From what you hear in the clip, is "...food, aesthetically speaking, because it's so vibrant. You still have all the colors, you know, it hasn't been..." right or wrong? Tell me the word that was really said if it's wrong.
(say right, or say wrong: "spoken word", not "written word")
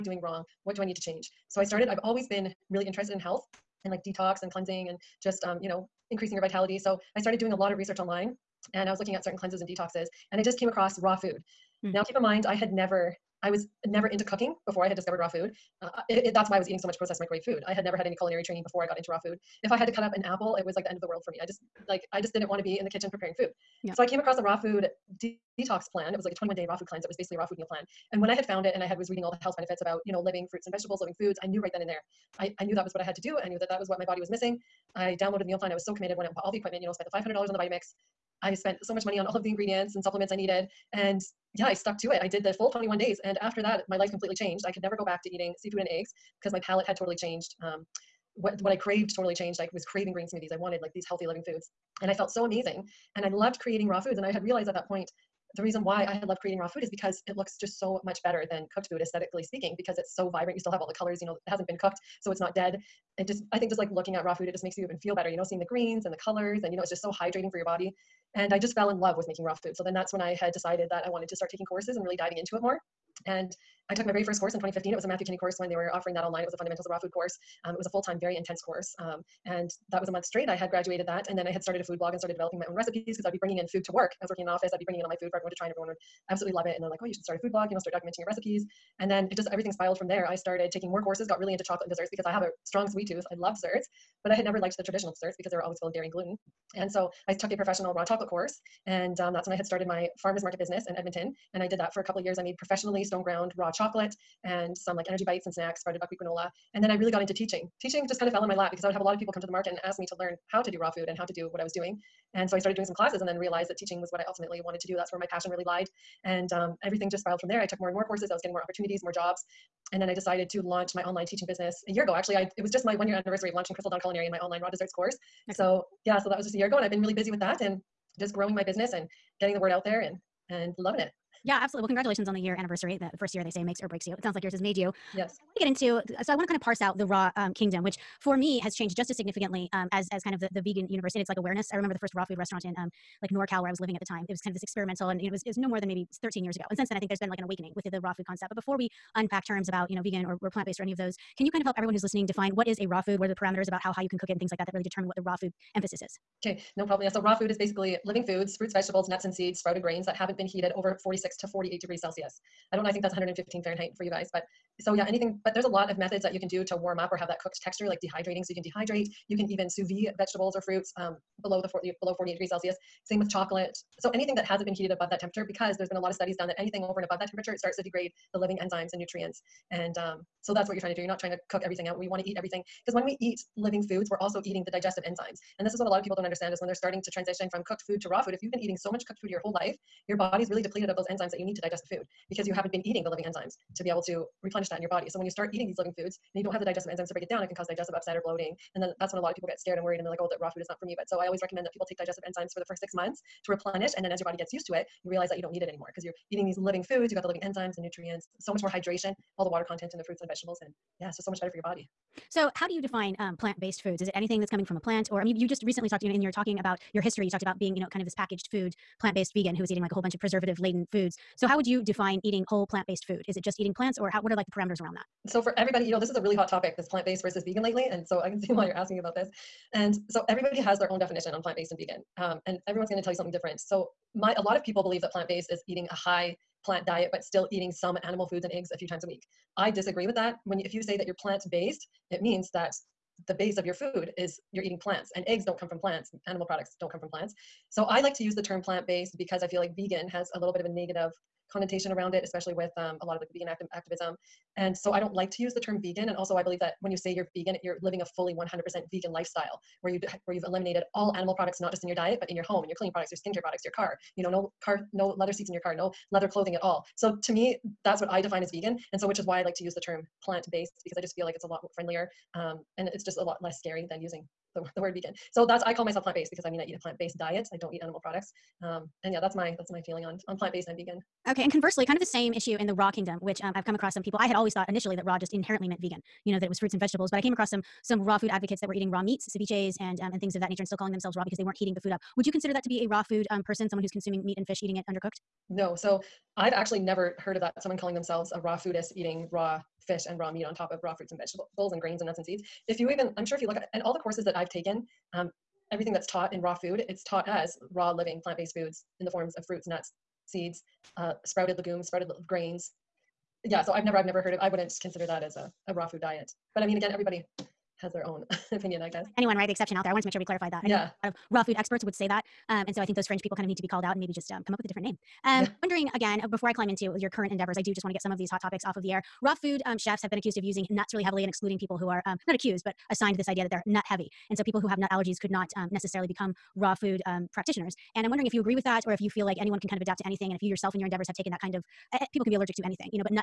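right.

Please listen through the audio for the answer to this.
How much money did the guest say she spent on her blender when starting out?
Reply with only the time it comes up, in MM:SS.
00:37.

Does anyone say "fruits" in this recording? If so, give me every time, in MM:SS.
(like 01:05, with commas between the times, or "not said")
00:30, 02:38, 02:50, 03:30, 04:46, 05:00, 05:09.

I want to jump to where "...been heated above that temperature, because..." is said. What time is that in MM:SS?
02:54.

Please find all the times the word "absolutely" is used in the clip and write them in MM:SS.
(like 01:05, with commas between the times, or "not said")
01:26, 02:11.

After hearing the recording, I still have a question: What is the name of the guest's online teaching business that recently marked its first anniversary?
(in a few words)
Crystal Dawn Culinary.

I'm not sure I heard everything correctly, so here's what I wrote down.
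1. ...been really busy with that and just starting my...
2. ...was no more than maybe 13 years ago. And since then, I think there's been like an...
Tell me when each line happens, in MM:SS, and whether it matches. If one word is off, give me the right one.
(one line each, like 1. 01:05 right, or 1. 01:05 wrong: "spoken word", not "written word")
1. 02:06 wrong: "growing", not "starting"
2. 02:25 right.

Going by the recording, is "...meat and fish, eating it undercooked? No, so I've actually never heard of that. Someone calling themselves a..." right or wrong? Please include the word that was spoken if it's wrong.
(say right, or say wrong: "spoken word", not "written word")
right.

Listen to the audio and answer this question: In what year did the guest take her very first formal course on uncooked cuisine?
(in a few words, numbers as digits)
2015.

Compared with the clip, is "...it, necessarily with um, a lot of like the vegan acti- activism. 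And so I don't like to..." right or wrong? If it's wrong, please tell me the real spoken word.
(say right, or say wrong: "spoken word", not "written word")
wrong: "especially", not "necessarily".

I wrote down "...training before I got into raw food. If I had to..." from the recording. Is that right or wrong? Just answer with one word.
right.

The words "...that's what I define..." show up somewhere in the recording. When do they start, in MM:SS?
04:27.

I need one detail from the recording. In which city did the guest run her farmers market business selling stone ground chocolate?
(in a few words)
Edmonton.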